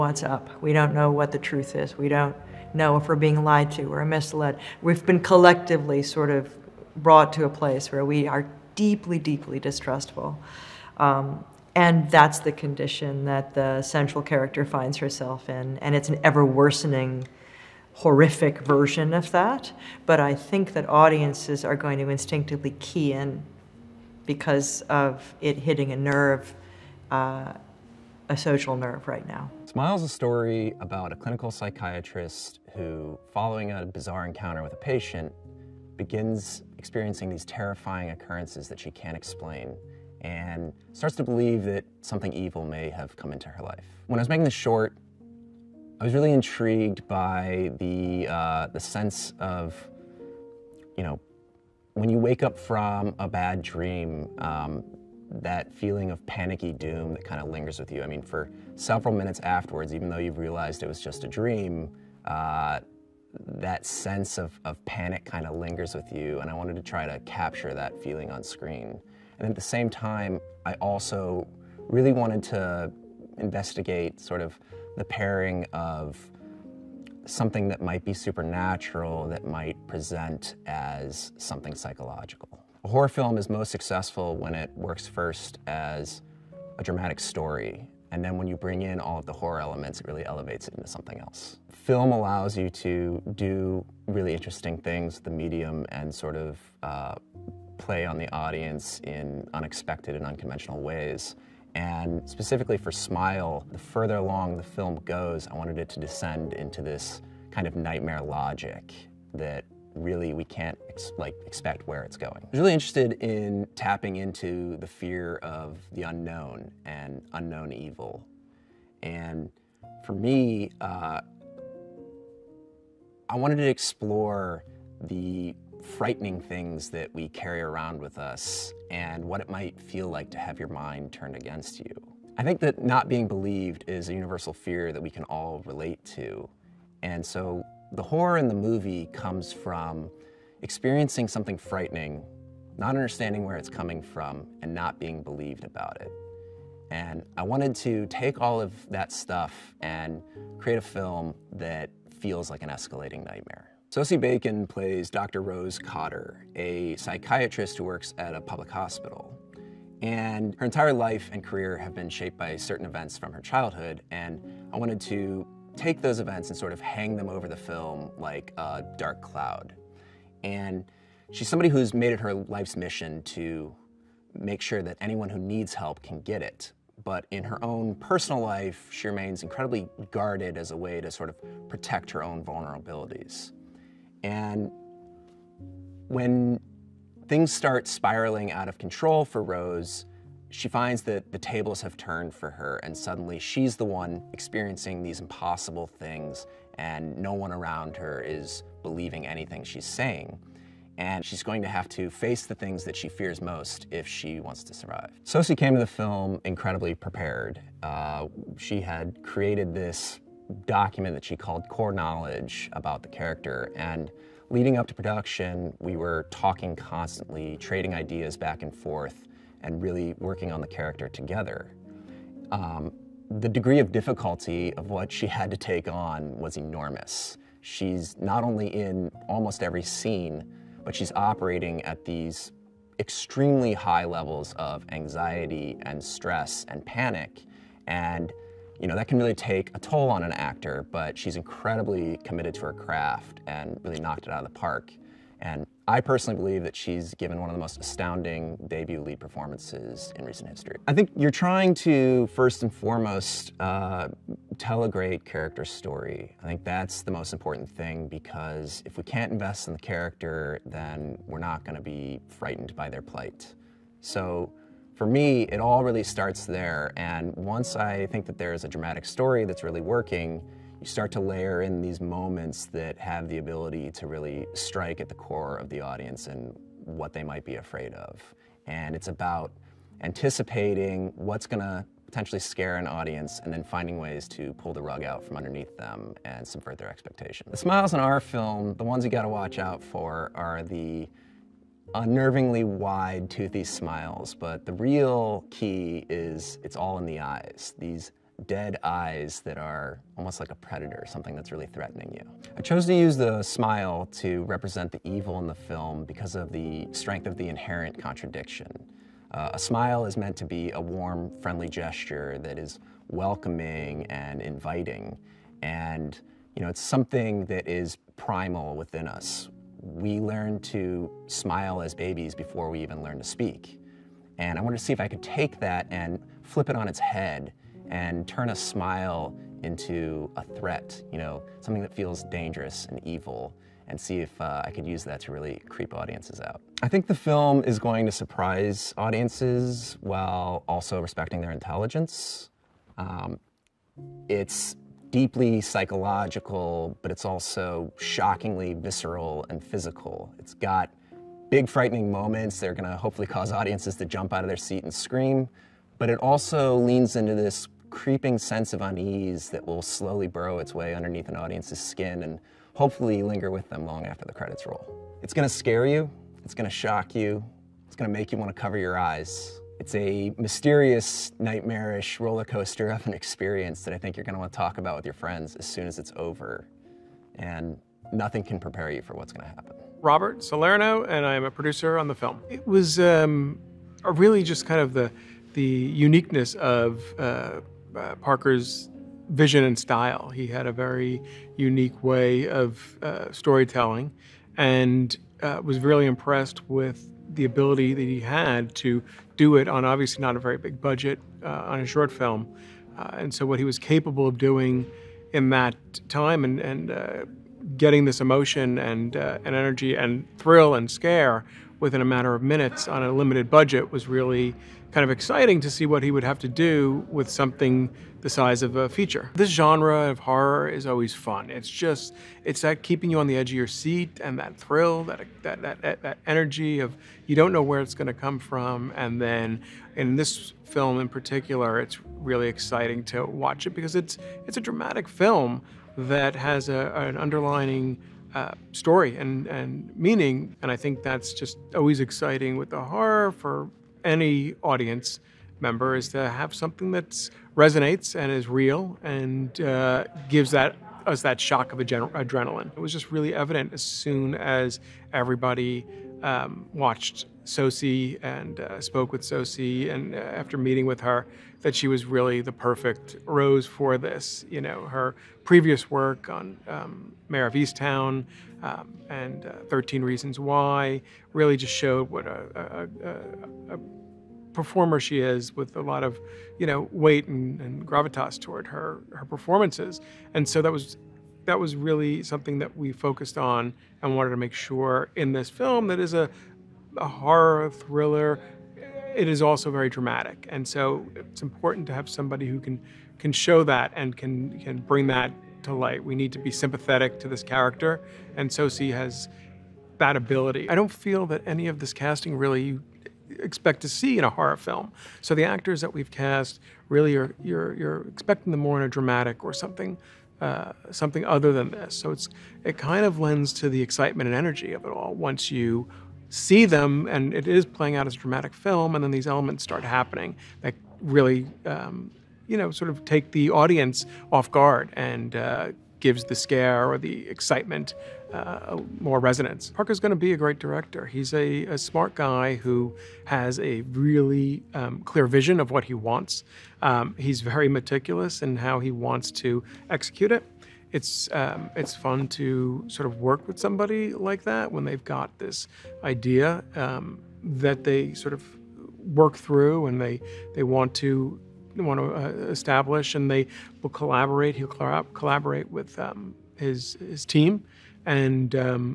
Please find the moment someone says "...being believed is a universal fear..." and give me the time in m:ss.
2:13.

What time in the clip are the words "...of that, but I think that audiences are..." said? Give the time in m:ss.
0:19.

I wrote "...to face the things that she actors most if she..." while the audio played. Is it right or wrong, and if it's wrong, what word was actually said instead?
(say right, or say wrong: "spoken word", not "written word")
wrong: "fears", not "actors".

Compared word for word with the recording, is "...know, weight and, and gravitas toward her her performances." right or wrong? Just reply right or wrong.
right.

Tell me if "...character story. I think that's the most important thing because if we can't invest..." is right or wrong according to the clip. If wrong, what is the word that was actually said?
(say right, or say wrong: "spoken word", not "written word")
right.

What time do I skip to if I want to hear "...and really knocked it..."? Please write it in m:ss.
4:03.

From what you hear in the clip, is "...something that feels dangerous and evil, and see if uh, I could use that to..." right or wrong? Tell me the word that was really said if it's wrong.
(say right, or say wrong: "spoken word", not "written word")
right.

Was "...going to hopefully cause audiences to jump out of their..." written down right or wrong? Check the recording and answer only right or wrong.
right.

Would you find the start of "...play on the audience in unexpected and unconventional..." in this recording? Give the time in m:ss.
1:37.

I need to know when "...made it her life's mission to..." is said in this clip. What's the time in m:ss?
2:51.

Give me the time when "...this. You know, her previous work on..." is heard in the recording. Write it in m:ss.
7:43.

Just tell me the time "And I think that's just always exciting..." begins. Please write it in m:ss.
7:20.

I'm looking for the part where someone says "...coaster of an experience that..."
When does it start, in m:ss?
6:12.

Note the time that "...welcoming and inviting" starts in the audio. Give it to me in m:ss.
5:13.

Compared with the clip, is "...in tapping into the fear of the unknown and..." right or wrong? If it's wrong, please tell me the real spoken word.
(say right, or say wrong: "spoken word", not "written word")
right.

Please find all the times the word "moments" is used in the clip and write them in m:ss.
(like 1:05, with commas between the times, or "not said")
4:32, 5:52.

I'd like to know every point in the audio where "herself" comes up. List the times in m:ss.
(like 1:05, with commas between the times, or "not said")
0:14.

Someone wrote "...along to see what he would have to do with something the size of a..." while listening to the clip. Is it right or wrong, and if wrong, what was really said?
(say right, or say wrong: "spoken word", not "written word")
wrong: "exciting", not "along".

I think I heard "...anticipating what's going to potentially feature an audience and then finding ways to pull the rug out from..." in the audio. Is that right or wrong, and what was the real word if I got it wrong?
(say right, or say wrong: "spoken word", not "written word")
wrong: "scare", not "feature".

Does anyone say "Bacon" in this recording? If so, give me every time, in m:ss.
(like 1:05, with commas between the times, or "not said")
2:34.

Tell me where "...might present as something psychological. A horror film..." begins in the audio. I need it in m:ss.
1:19.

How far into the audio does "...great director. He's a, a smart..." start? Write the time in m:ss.
8:50.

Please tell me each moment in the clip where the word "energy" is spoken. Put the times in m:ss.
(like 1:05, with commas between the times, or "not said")
6:49, 7:06, 8:34.